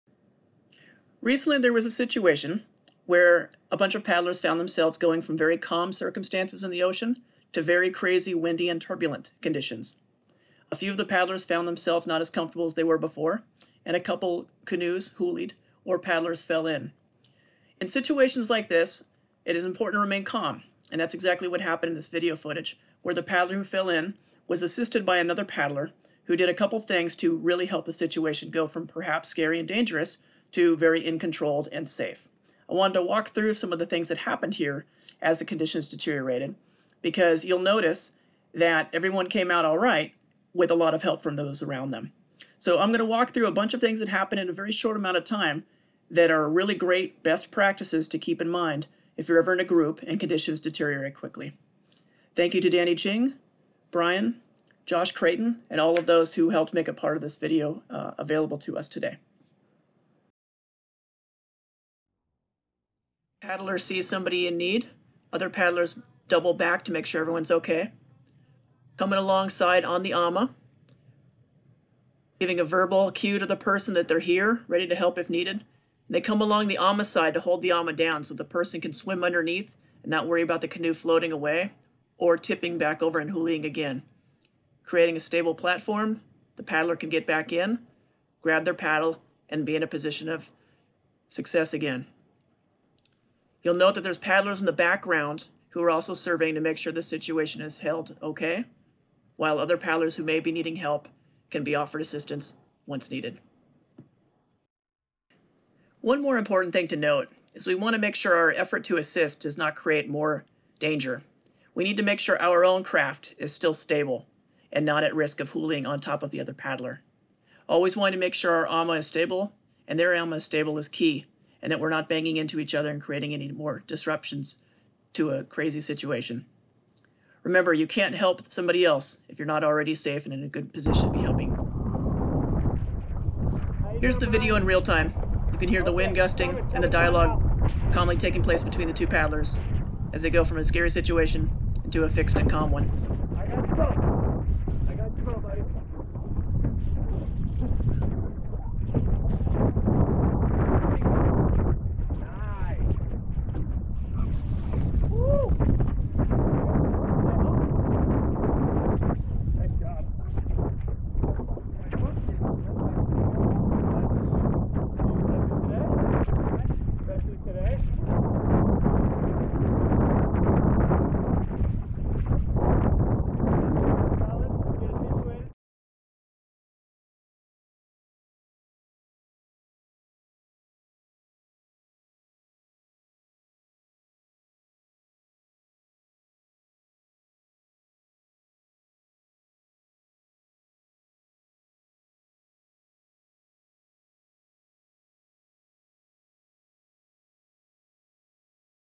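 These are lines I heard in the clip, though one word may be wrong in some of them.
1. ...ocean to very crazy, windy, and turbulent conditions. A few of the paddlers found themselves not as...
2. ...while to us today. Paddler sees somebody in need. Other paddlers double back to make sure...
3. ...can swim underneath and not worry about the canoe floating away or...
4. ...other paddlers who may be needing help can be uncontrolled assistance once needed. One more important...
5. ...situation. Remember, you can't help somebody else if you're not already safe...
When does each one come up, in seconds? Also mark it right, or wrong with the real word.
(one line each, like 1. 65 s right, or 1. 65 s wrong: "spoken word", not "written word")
1. 6 s right
2. 58 s wrong: "available", not "while"
3. 78 s right
4. 99 s wrong: "offered", not "uncontrolled"
5. 125 s right.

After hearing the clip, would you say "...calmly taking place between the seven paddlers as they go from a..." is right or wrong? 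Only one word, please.
wrong.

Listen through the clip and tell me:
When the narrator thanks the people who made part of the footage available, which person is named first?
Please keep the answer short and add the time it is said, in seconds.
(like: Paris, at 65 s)
Danny Ching, at 52 s.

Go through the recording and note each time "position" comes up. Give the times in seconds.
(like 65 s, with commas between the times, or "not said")
89 s, 130 s.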